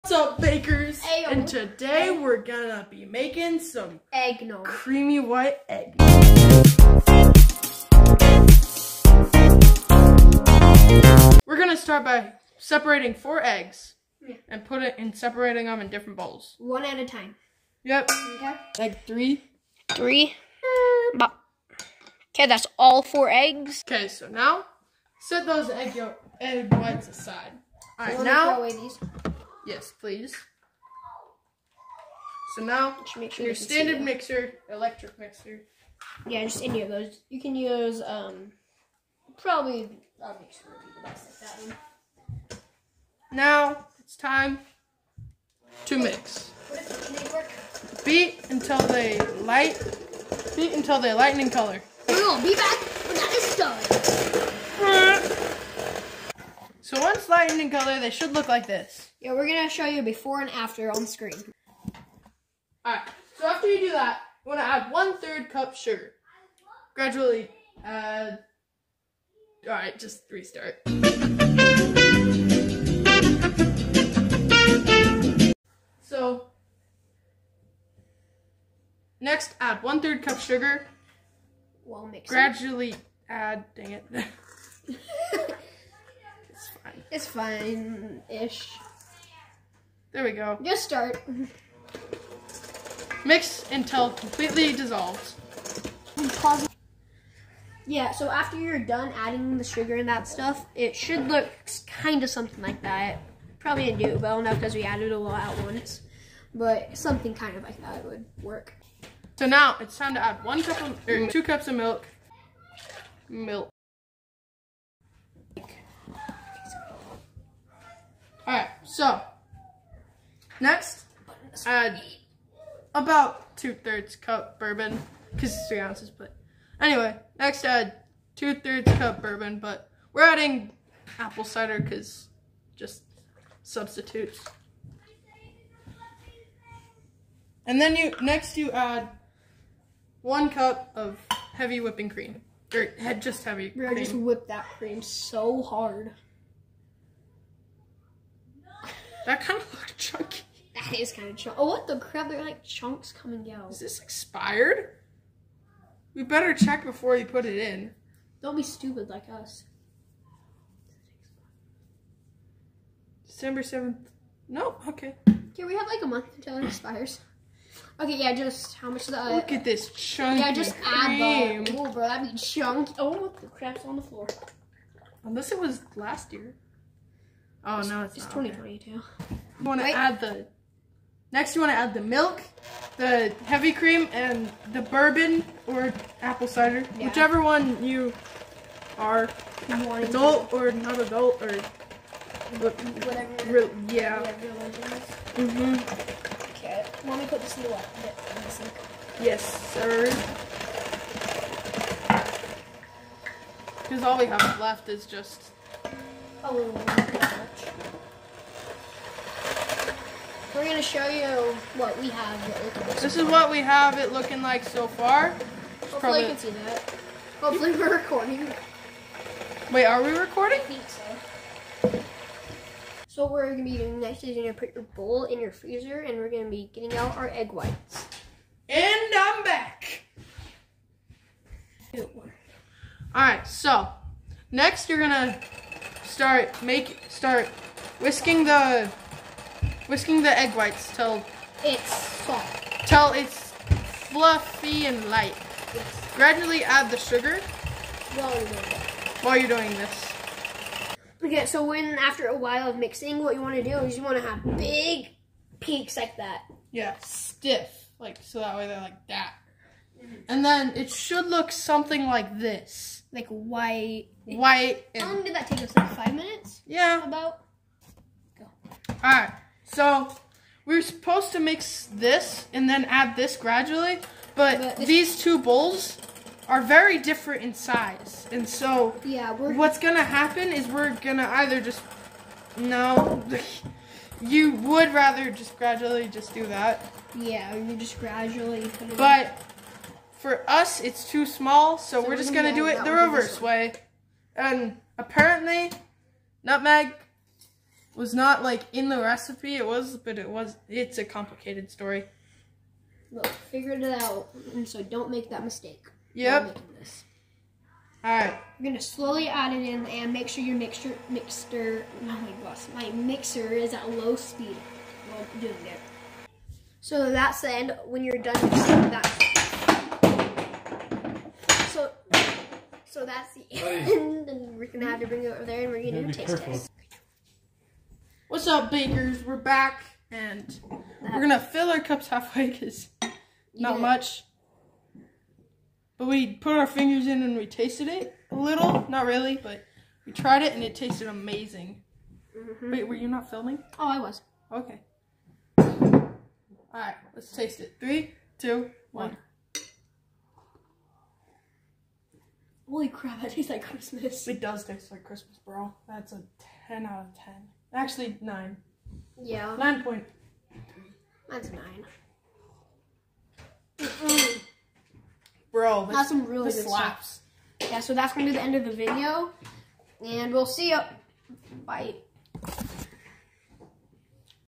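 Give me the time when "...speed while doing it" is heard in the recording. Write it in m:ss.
5:14.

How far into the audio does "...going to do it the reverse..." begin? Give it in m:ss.
4:52.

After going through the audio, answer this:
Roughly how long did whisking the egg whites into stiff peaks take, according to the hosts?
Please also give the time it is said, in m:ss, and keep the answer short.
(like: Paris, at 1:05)
5 minutes, at 4:25.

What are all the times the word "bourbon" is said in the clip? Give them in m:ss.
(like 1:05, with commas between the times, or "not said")
2:04, 2:09, 3:04.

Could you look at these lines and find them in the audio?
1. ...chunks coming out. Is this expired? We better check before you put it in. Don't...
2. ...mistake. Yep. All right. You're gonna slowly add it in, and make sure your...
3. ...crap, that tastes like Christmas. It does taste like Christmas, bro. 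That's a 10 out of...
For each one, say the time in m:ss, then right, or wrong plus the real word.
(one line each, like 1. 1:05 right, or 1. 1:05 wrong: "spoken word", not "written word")
1. 2:32 right
2. 5:05 right
3. 5:52 right.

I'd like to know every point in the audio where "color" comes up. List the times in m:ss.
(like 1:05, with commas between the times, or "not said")
0:51, 0:57.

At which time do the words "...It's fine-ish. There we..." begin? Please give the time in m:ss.
1:27.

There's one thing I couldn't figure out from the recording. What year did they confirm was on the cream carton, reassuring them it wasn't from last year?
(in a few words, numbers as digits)
2022.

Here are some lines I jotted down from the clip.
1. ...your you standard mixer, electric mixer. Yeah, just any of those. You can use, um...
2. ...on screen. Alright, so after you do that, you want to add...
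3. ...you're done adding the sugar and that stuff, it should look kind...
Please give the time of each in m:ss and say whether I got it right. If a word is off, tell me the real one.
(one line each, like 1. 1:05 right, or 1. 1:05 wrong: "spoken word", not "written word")
1. 0:33 right
2. 1:00 right
3. 1:38 right.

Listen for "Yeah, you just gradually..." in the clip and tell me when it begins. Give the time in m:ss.
4:47.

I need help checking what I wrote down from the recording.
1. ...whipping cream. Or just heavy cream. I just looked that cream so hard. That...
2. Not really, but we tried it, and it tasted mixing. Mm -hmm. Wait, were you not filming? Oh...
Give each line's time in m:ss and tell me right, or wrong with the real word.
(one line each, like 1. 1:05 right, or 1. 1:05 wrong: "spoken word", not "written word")
1. 2:21 wrong: "whipped", not "looked"
2. 5:38 wrong: "amazing", not "mixing".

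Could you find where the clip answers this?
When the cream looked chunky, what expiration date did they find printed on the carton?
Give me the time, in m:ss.
2:43.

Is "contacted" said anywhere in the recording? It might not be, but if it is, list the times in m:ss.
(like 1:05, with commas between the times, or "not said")
not said.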